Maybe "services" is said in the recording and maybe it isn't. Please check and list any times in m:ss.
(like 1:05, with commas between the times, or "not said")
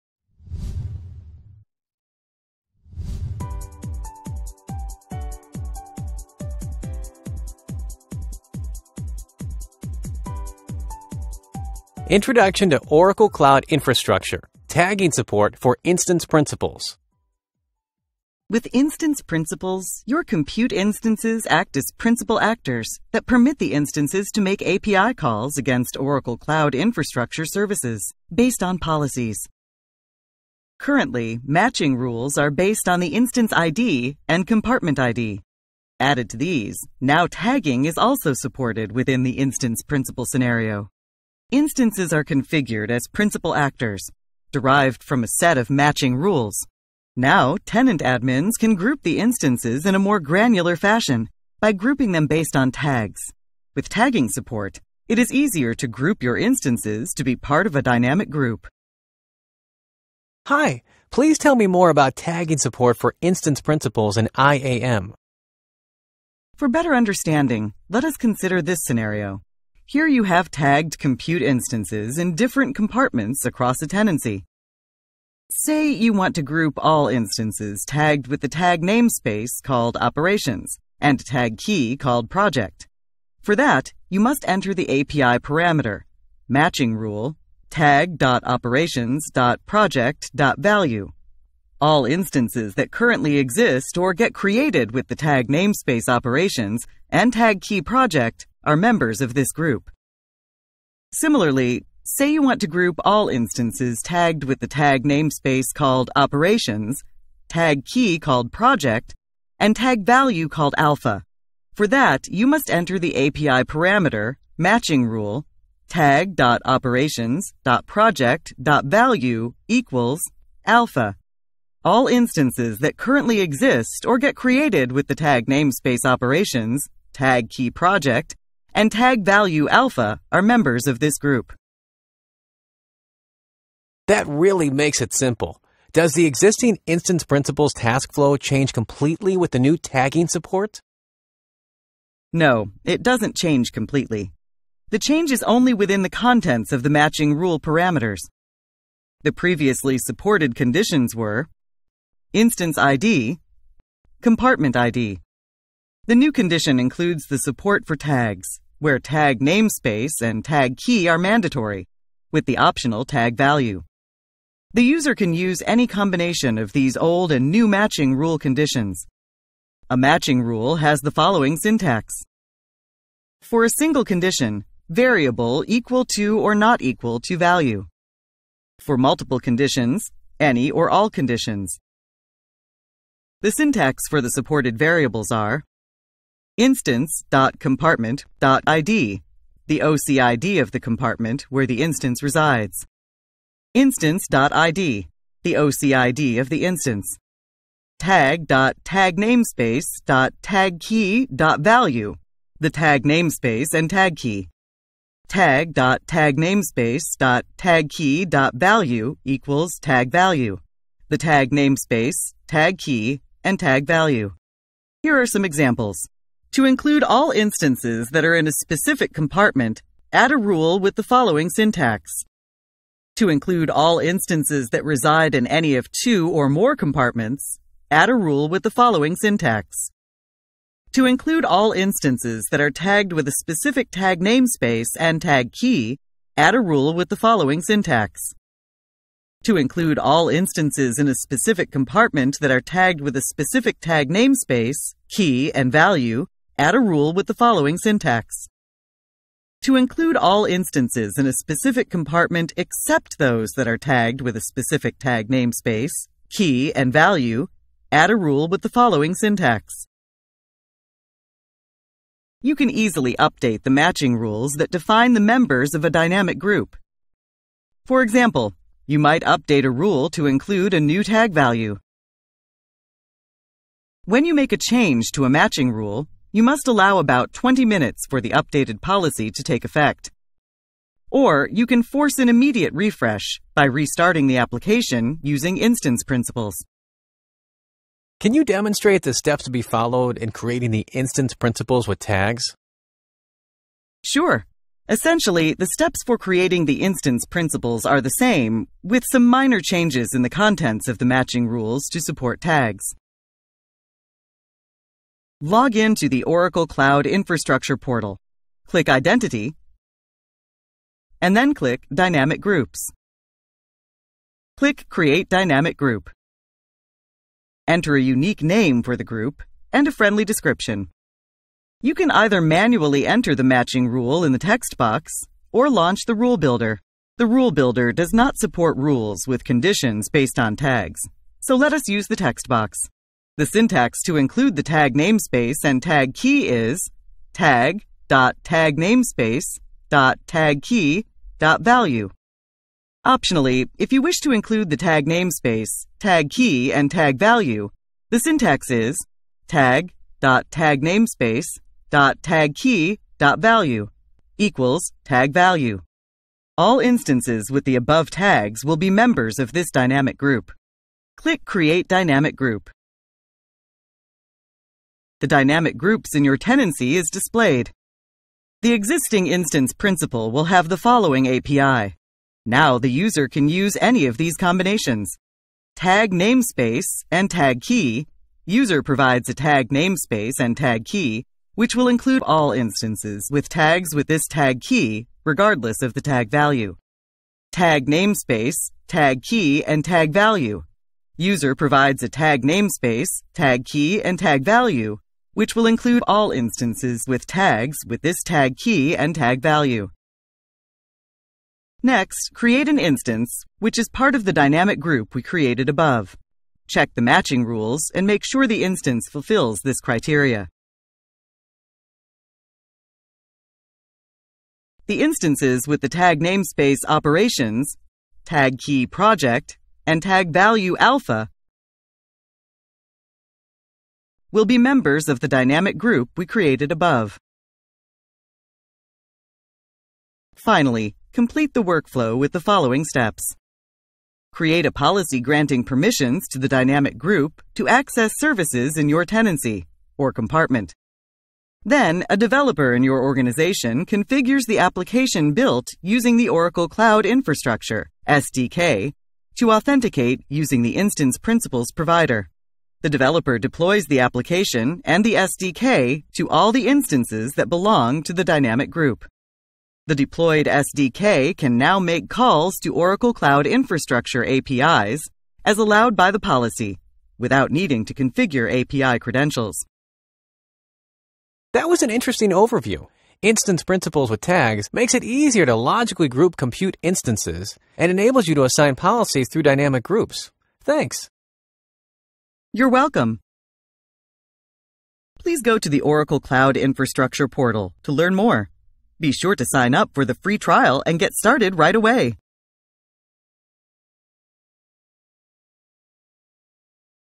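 0:27, 7:18.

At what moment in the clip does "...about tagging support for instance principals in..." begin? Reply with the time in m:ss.
1:01.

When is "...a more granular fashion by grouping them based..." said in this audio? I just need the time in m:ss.
0:49.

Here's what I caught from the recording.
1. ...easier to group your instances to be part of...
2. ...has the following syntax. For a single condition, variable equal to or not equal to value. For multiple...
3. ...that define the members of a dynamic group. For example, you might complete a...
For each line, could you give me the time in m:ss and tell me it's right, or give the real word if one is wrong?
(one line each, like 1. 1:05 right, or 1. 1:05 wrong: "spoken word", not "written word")
1. 0:55 right
2. 2:50 right
3. 4:24 wrong: "update", not "complete".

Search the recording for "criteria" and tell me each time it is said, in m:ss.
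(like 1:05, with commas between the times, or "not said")
6:49.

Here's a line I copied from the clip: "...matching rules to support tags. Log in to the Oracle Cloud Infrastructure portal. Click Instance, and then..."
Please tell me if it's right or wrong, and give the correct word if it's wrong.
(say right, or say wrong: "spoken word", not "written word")
wrong: "Identity", not "Instance".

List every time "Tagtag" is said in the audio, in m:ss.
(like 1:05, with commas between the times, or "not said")
3:17, 3:25.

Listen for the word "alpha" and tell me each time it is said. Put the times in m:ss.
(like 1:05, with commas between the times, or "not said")
1:50, 2:00, 2:09, 7:00.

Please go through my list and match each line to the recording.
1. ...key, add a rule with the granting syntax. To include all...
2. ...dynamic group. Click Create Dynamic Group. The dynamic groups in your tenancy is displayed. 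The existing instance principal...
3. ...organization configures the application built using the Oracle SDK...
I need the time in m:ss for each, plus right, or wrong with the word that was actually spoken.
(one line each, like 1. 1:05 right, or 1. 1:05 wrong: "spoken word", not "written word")
1. 3:55 wrong: "following", not "granting"
2. 5:59 right
3. 7:23 wrong: "Cloud", not "SDK".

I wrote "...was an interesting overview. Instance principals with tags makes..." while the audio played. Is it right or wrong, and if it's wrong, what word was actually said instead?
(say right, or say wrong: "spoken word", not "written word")
right.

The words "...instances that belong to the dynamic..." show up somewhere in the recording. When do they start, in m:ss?
7:36.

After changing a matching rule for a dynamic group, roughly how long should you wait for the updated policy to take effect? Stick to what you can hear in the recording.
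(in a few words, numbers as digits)
20 minutes.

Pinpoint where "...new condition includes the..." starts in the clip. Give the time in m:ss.
2:36.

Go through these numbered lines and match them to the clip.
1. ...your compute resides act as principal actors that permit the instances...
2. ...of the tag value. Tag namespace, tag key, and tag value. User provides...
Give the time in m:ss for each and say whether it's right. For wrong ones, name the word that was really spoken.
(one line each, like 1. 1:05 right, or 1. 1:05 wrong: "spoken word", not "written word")
1. 0:20 wrong: "instances", not "resides"
2. 6:25 right.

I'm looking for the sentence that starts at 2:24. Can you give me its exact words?
The change is only within the contents of the matching rule parameters.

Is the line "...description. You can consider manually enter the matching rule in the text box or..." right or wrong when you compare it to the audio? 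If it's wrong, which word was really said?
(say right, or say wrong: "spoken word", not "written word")
wrong: "either", not "consider".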